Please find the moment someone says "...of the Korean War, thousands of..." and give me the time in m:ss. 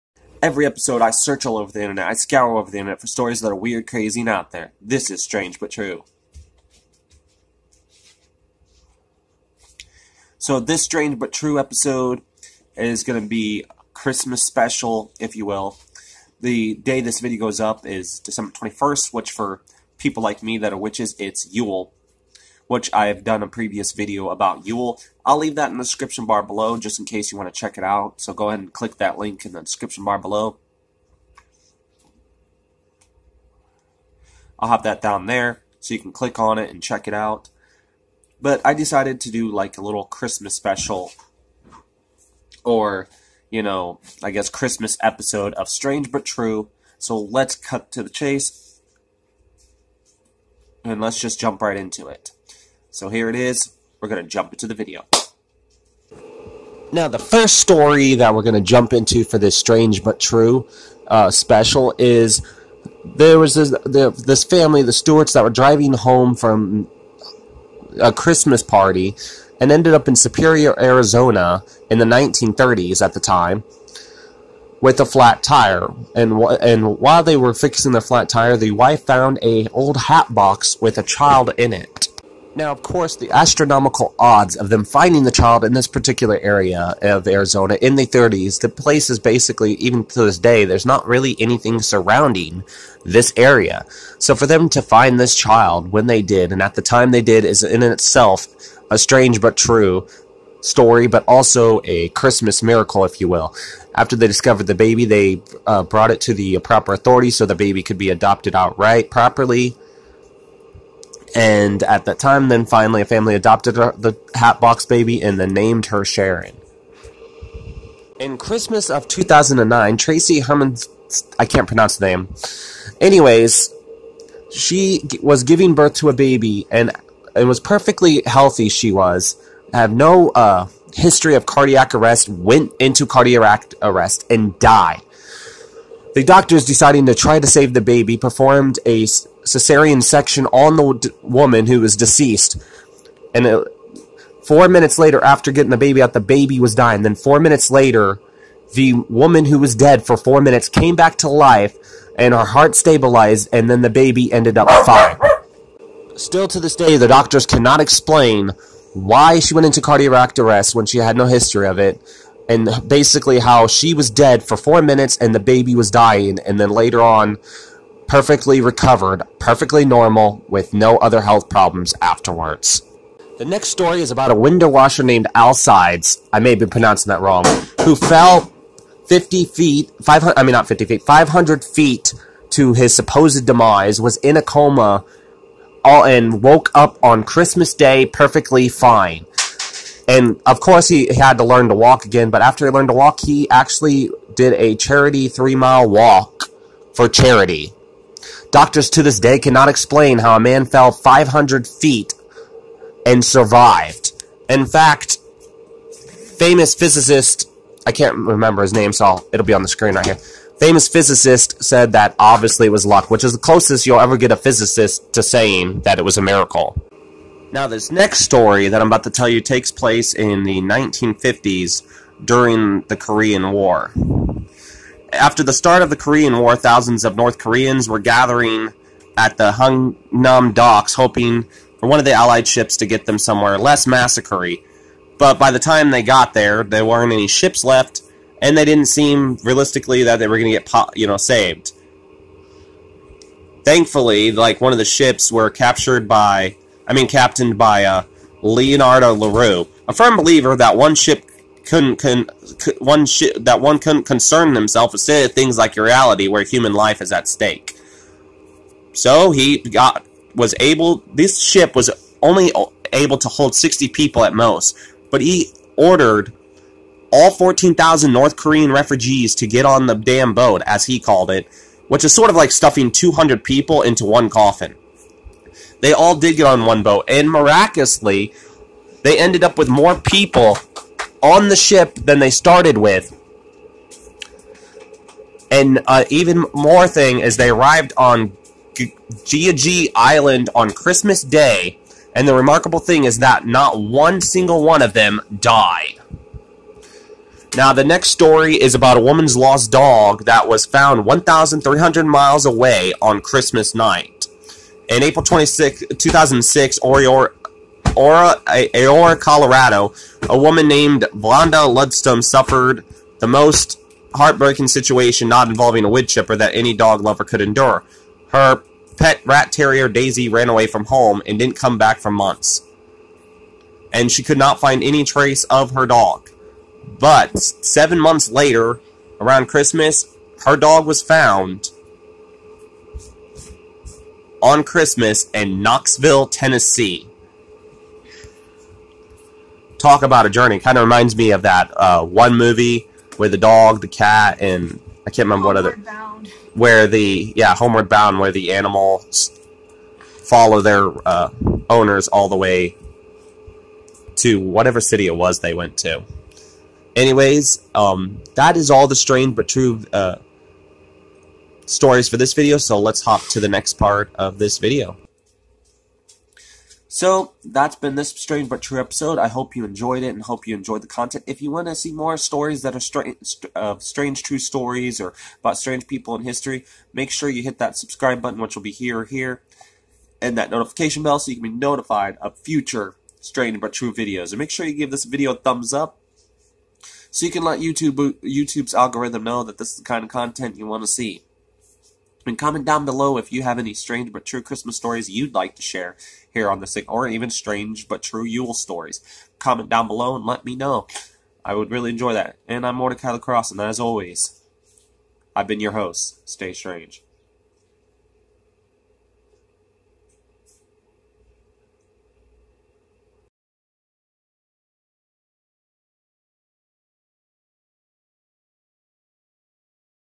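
3:45.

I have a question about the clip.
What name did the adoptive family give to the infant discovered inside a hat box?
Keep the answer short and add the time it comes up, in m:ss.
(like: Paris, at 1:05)
Sharon, at 1:56.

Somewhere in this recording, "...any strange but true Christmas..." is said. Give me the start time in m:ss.
6:33.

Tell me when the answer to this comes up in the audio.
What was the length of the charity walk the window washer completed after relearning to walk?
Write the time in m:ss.
3:15.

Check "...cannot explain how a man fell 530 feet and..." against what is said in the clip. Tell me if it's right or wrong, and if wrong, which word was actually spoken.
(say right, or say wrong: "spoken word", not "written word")
wrong: "500", not "530".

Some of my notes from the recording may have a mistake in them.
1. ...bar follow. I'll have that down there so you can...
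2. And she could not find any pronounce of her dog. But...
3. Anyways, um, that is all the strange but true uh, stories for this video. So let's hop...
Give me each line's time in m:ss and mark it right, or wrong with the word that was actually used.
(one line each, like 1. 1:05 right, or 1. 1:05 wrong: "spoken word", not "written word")
1. 0:30 wrong: "below", not "follow"
2. 5:23 wrong: "trace", not "pronounce"
3. 5:56 right.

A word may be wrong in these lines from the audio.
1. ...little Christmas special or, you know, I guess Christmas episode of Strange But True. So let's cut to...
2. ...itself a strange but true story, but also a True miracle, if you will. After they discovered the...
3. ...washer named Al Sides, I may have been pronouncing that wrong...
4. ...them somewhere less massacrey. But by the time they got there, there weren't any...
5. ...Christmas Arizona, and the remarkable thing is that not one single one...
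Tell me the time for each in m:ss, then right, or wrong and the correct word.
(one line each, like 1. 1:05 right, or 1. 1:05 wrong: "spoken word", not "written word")
1. 0:39 right
2. 1:37 wrong: "Christmas", not "True"
3. 2:54 right
4. 3:53 right
5. 4:50 wrong: "Day", not "Arizona".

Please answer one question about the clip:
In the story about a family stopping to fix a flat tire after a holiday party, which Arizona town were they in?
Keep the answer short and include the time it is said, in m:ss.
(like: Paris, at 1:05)
Superior, at 1:10.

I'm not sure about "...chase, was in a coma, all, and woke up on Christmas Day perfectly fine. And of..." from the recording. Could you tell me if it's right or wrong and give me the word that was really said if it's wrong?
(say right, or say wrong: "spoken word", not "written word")
wrong: "demise", not "chase".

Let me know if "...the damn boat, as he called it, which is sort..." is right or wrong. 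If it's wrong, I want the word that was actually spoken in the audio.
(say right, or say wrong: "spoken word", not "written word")
right.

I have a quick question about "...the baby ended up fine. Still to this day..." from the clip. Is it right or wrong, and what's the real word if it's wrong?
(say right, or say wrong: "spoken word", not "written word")
right.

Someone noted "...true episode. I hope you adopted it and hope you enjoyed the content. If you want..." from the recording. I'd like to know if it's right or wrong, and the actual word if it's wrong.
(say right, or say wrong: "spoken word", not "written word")
wrong: "enjoyed", not "adopted".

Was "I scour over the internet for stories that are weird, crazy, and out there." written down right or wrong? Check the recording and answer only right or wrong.
right.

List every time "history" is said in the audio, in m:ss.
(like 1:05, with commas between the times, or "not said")
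2:10, 2:41, 6:16.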